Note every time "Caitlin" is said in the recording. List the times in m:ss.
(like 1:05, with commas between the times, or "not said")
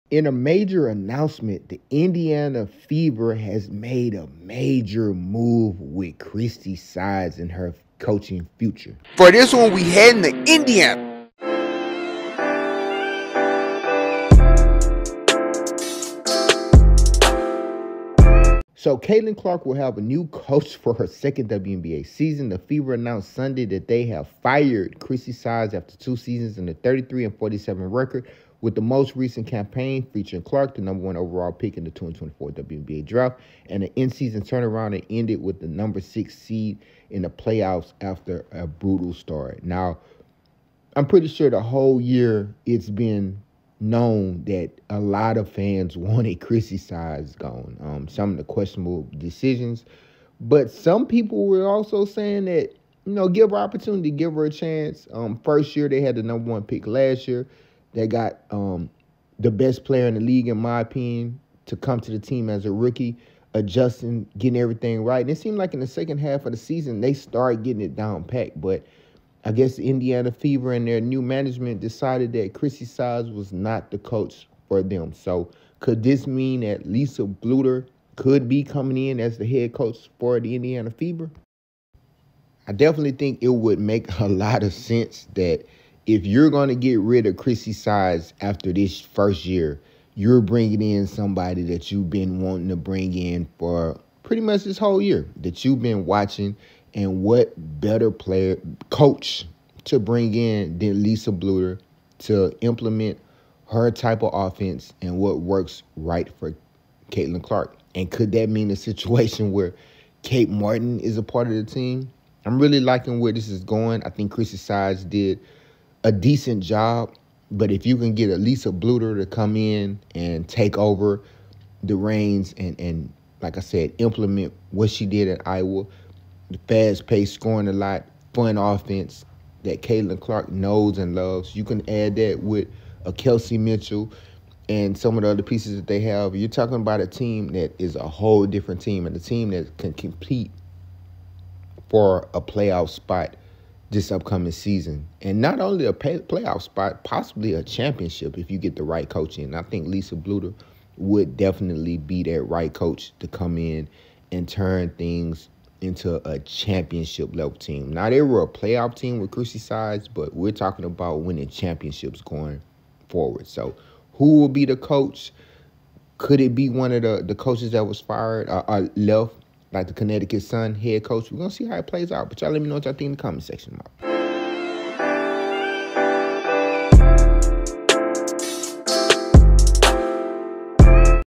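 0:18, 1:47, 2:09.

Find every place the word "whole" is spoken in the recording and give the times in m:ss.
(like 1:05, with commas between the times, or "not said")
0:41, 1:34, 2:18.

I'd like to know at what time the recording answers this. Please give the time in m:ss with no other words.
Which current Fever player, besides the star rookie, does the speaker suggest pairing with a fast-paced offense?
2:13.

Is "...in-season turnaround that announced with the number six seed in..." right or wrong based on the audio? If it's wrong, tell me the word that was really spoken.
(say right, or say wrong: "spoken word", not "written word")
wrong: "ended", not "announced".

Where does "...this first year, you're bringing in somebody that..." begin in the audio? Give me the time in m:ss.
1:28.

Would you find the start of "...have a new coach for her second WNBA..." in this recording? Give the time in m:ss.
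0:19.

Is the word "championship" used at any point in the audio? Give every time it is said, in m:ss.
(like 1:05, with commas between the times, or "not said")
2:27, 2:36, 2:41.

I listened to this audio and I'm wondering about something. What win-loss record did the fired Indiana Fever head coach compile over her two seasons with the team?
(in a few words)
33-47.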